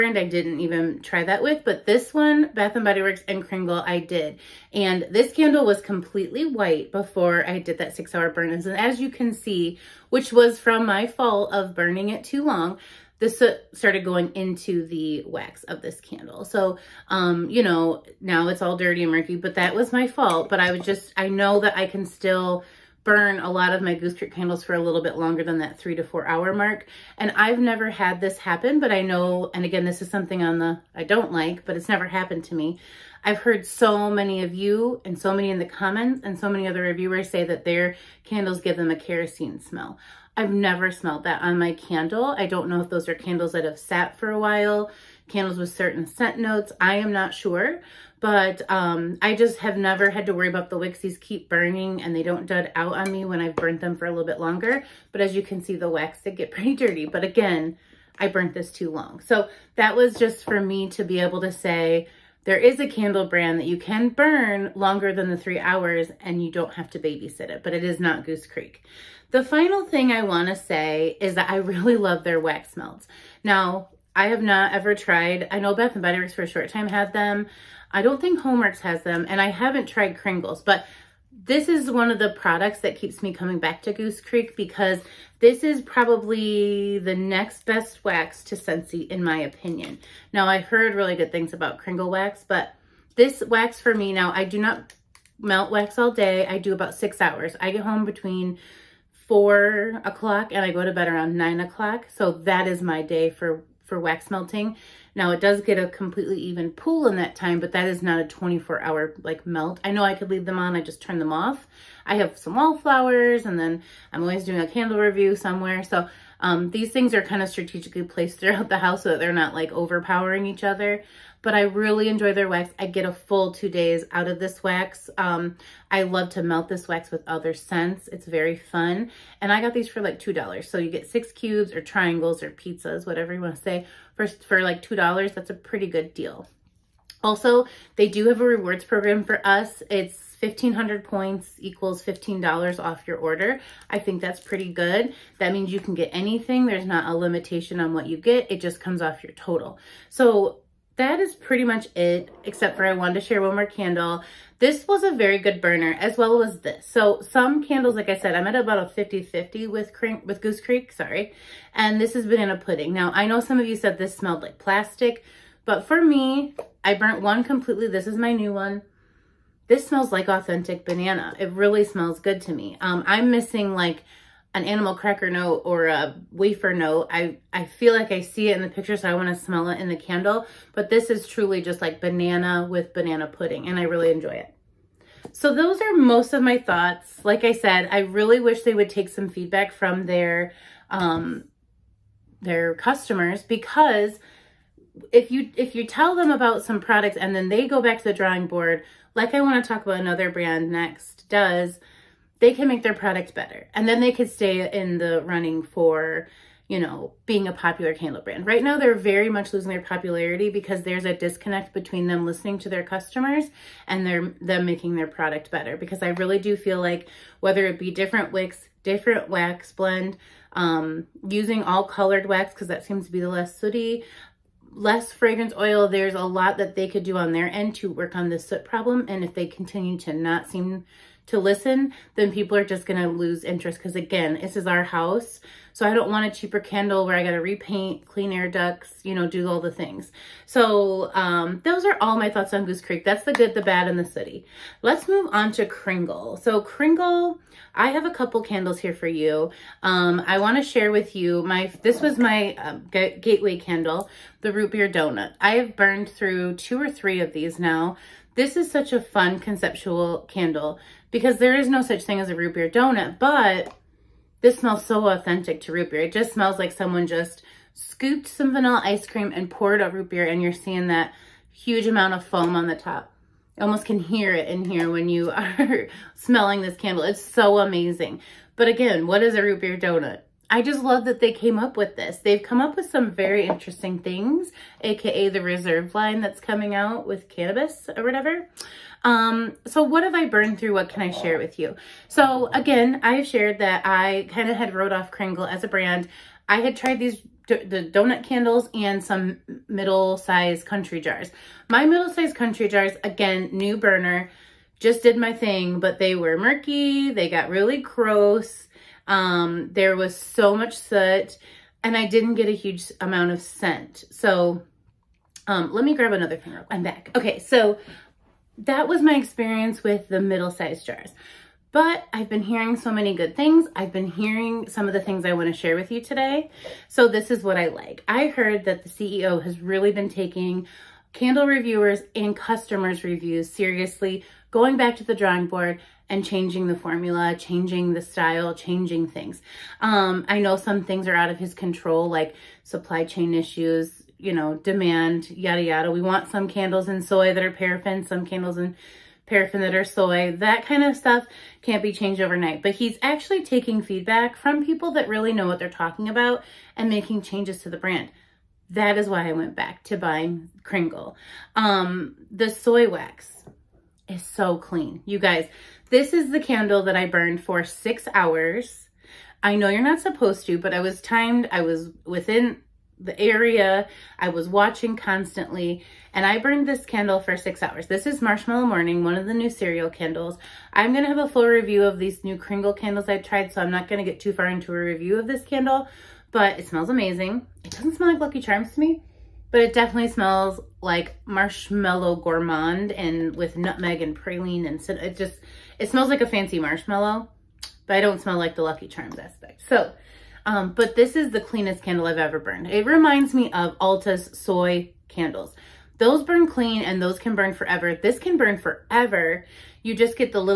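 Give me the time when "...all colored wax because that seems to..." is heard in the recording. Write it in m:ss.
3:41.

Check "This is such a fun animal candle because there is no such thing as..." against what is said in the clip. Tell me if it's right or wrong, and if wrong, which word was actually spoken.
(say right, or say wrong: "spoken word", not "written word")
wrong: "conceptual", not "animal".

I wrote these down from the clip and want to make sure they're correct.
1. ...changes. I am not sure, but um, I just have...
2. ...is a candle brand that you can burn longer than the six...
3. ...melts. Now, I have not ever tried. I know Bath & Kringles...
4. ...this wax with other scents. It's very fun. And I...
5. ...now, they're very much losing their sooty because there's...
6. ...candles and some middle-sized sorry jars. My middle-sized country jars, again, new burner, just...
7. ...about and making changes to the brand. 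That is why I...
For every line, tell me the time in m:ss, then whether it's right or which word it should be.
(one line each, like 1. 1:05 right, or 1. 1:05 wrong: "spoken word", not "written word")
1. 0:46 wrong: "notes", not "changes"
2. 1:02 wrong: "three", not "six"
3. 1:12 wrong: "Body", not "Kringles"
4. 2:06 right
5. 3:28 wrong: "popularity", not "sooty"
6. 4:58 wrong: "country", not "sorry"
7. 5:56 right.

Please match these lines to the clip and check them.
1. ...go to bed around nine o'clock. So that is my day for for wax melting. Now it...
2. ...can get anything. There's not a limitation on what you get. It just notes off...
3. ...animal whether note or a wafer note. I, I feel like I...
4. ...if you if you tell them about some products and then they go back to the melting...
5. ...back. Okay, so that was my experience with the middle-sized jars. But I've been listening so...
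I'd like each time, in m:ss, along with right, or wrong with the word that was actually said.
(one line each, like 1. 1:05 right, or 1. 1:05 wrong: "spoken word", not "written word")
1. 1:40 right
2. 2:25 wrong: "comes", not "notes"
3. 2:54 wrong: "cracker", not "whether"
4. 3:15 wrong: "drawing", not "melting"
5. 5:16 wrong: "hearing", not "listening".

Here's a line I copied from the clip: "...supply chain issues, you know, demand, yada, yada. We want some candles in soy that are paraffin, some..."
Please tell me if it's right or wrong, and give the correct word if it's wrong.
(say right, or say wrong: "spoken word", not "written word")
right.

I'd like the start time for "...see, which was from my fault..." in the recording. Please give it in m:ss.
0:09.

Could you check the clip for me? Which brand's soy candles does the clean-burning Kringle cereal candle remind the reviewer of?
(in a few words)
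Alta.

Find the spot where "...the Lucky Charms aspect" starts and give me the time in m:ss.
6:38.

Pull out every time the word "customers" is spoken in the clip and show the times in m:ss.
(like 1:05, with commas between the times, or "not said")
3:12, 3:32, 5:32.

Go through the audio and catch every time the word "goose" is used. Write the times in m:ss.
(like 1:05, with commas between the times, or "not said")
0:23, 1:08, 1:23, 2:40, 4:02.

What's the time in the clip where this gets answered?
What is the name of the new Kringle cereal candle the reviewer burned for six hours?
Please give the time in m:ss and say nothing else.
6:18.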